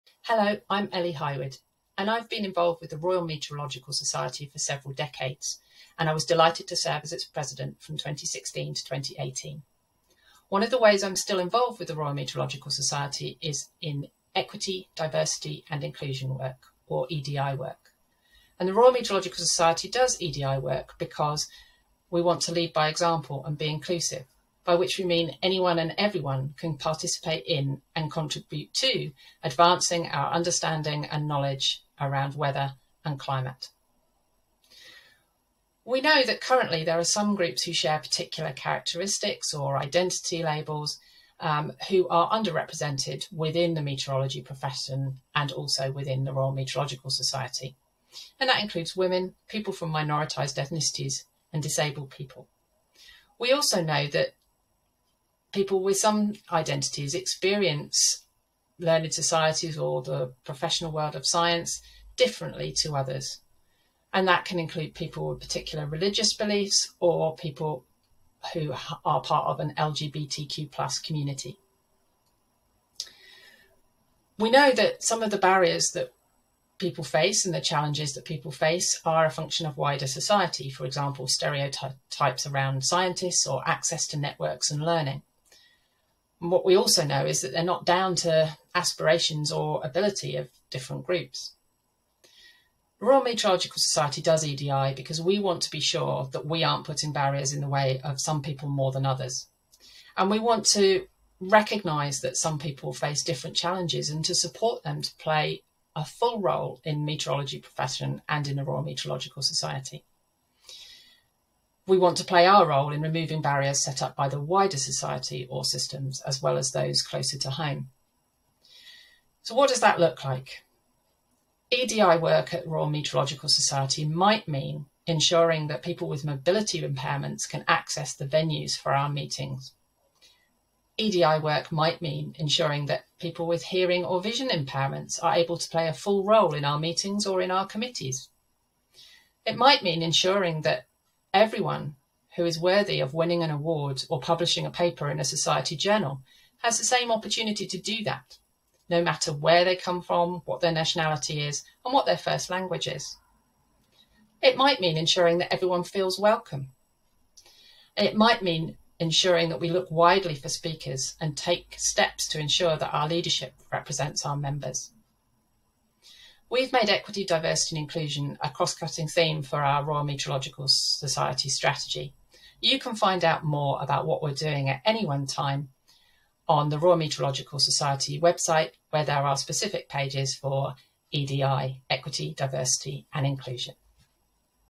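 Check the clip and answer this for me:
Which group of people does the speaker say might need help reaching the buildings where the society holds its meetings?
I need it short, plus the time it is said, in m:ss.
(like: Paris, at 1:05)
People with mobility impairments, at 2:06.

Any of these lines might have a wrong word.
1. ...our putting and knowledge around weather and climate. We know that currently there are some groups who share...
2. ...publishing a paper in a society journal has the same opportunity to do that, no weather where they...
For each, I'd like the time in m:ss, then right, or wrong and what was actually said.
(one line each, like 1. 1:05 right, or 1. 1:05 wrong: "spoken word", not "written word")
1. 0:30 wrong: "understanding", not "putting"
2. 2:24 wrong: "matter", not "weather".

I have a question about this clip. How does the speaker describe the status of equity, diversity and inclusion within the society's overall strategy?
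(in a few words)
A cross cutting theme.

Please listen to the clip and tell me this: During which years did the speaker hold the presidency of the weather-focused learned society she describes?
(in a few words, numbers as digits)
2016 to 2018.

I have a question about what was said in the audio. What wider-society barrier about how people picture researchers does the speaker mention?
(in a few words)
Stereotypes around scientists.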